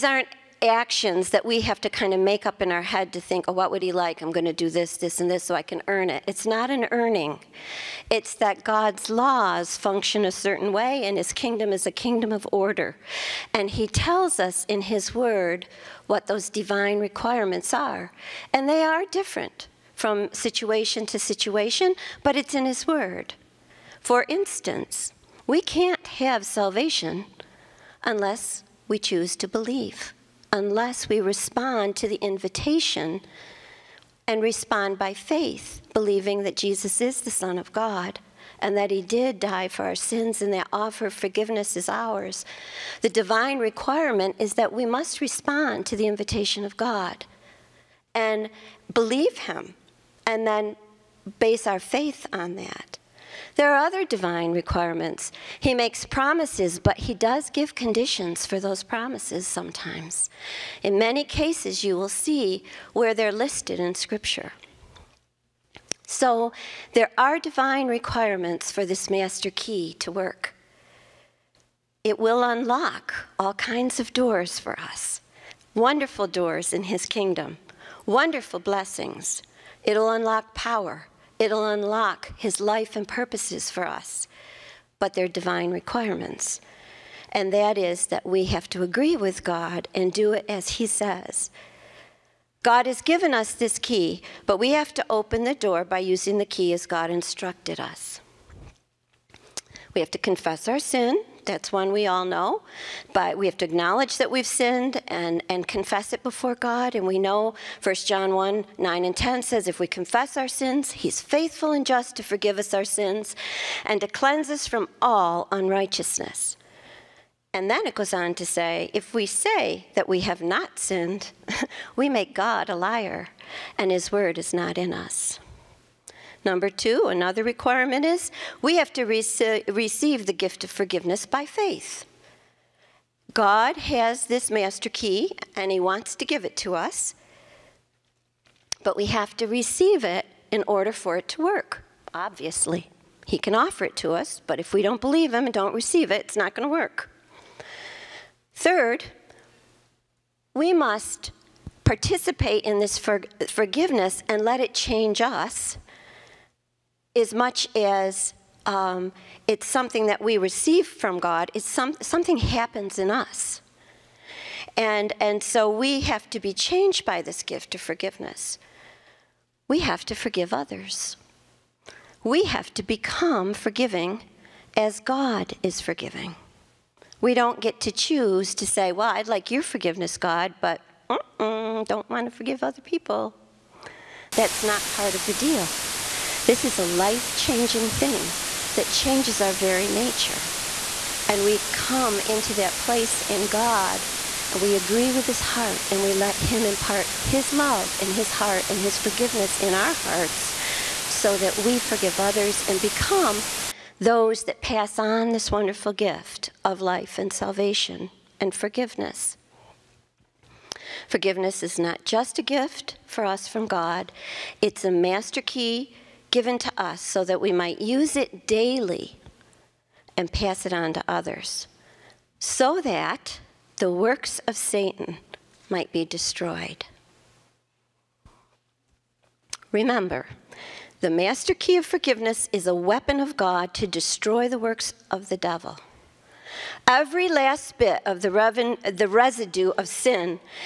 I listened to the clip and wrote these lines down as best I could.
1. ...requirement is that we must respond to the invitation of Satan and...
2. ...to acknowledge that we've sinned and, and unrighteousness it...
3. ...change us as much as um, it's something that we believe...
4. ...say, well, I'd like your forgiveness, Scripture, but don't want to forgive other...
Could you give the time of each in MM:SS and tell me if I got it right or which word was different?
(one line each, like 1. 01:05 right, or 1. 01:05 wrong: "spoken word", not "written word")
1. 00:43 wrong: "God", not "Satan"
2. 01:43 wrong: "confess", not "unrighteousness"
3. 02:34 wrong: "receive", not "believe"
4. 02:58 wrong: "God", not "Scripture".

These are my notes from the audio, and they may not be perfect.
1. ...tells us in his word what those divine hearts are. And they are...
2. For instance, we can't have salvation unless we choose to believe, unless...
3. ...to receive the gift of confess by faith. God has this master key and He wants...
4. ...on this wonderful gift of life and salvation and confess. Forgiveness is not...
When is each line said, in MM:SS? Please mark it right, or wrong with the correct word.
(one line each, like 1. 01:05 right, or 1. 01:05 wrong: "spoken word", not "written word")
1. 00:13 wrong: "requirements", not "hearts"
2. 00:24 right
3. 02:08 wrong: "forgiveness", not "confess"
4. 03:24 wrong: "forgiveness", not "confess".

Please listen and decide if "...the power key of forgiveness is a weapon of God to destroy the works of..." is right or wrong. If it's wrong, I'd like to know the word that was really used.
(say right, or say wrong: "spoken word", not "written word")
wrong: "master", not "power".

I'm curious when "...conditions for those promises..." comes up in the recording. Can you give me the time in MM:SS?
00:57.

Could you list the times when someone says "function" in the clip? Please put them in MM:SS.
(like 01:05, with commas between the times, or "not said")
00:09.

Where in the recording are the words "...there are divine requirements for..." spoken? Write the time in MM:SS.
01:06.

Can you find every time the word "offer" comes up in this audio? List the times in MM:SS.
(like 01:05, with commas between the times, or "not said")
00:40, 02:23.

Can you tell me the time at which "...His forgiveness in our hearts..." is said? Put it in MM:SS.
03:18.